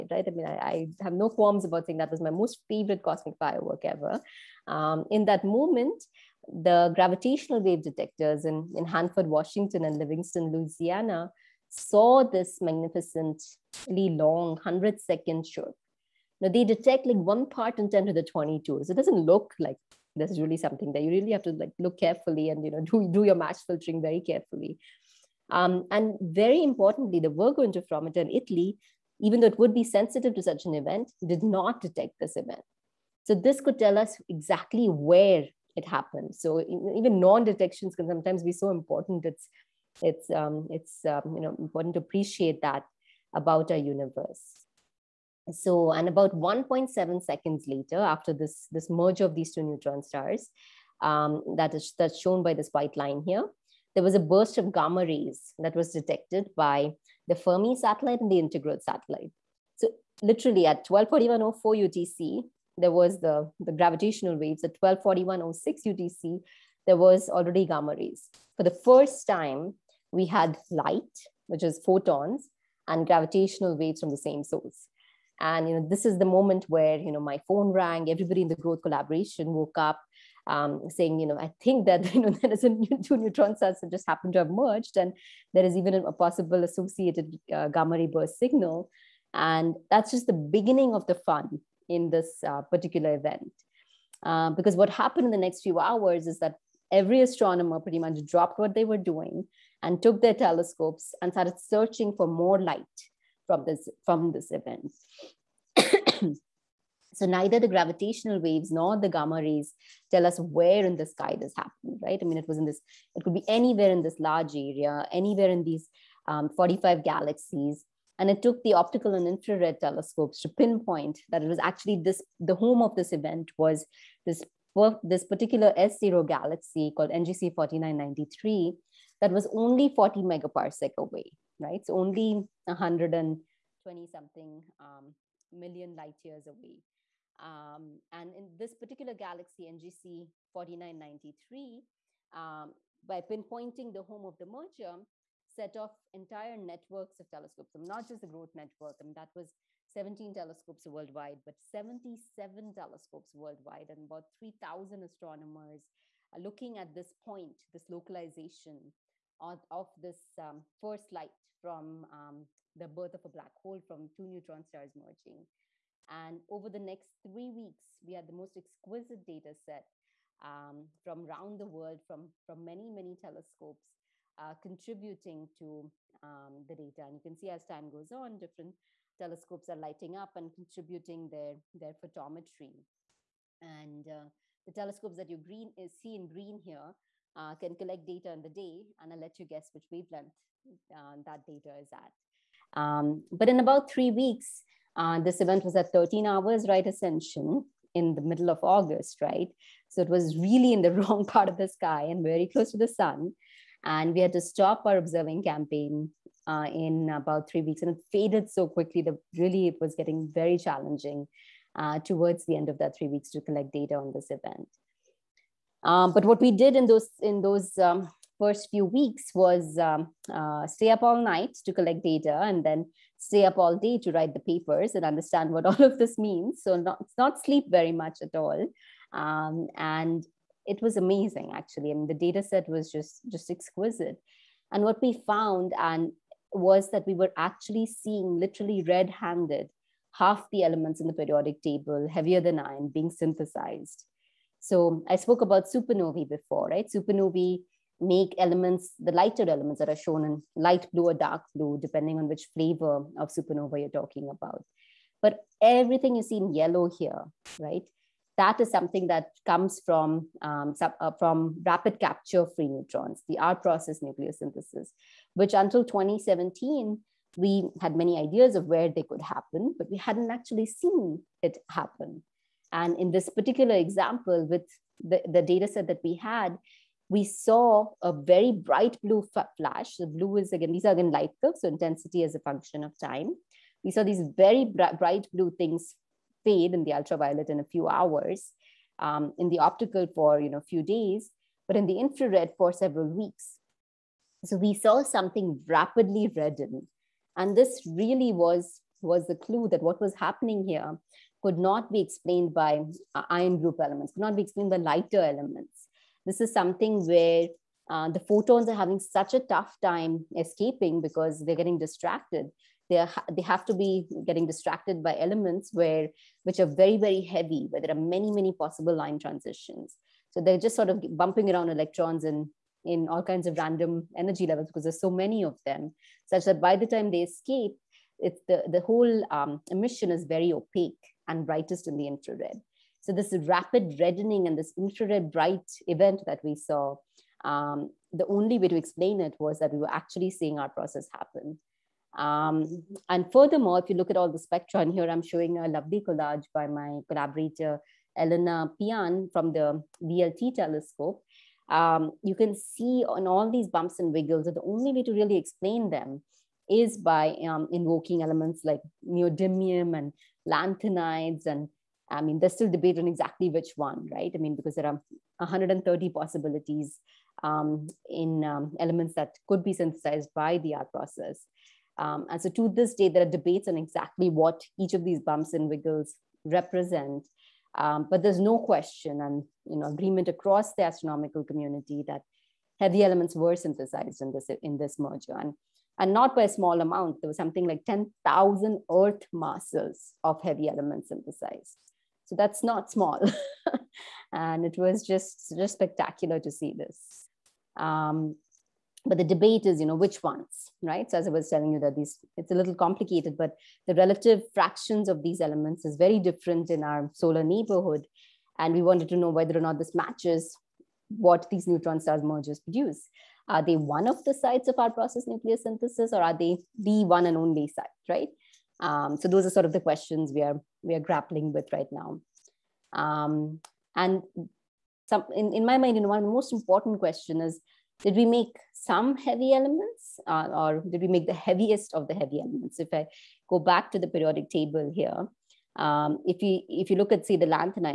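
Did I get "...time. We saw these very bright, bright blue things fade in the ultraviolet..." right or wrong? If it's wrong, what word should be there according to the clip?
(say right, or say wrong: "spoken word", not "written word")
right.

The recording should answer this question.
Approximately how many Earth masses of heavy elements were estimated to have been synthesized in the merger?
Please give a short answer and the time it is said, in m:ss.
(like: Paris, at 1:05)
10,000, at 6:27.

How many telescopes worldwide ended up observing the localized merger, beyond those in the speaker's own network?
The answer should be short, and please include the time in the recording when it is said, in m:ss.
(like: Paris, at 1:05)
77, at 2:31.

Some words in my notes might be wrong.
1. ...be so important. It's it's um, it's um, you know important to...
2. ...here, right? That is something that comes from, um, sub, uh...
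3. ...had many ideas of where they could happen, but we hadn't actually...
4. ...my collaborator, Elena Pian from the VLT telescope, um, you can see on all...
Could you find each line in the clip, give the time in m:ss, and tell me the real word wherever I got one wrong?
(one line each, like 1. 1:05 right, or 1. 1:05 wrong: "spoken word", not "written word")
1. 0:38 right
2. 4:16 right
3. 4:27 right
4. 5:46 right.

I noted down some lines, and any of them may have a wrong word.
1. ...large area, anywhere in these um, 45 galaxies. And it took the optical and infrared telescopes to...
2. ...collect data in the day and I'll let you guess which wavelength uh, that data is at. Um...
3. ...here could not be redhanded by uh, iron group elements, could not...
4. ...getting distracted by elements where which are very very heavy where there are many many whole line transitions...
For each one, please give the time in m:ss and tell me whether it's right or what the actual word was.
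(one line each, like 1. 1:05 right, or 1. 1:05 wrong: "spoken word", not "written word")
1. 1:54 right
2. 3:07 right
3. 5:00 wrong: "explained", not "redhanded"
4. 5:14 wrong: "possible", not "whole".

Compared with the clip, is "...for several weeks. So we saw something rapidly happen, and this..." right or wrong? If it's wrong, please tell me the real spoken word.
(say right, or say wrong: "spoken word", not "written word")
wrong: "redden", not "happen".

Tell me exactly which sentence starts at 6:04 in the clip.
I mean, because there are 130 possibilities um, in um, elements that could be synthesized by the R process.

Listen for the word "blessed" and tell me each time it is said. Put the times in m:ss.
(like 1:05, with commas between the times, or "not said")
not said.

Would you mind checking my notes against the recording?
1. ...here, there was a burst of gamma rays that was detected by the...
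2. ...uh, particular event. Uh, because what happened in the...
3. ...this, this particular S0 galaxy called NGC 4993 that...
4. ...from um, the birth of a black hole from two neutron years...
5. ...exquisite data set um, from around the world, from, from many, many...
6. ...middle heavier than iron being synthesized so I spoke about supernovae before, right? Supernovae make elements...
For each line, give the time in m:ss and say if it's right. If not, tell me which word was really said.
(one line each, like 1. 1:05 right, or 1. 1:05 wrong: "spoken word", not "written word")
1. 0:53 right
2. 1:32 right
3. 2:04 right
4. 2:41 wrong: "stars", not "years"
5. 2:48 right
6. 4:01 wrong: "table", not "middle".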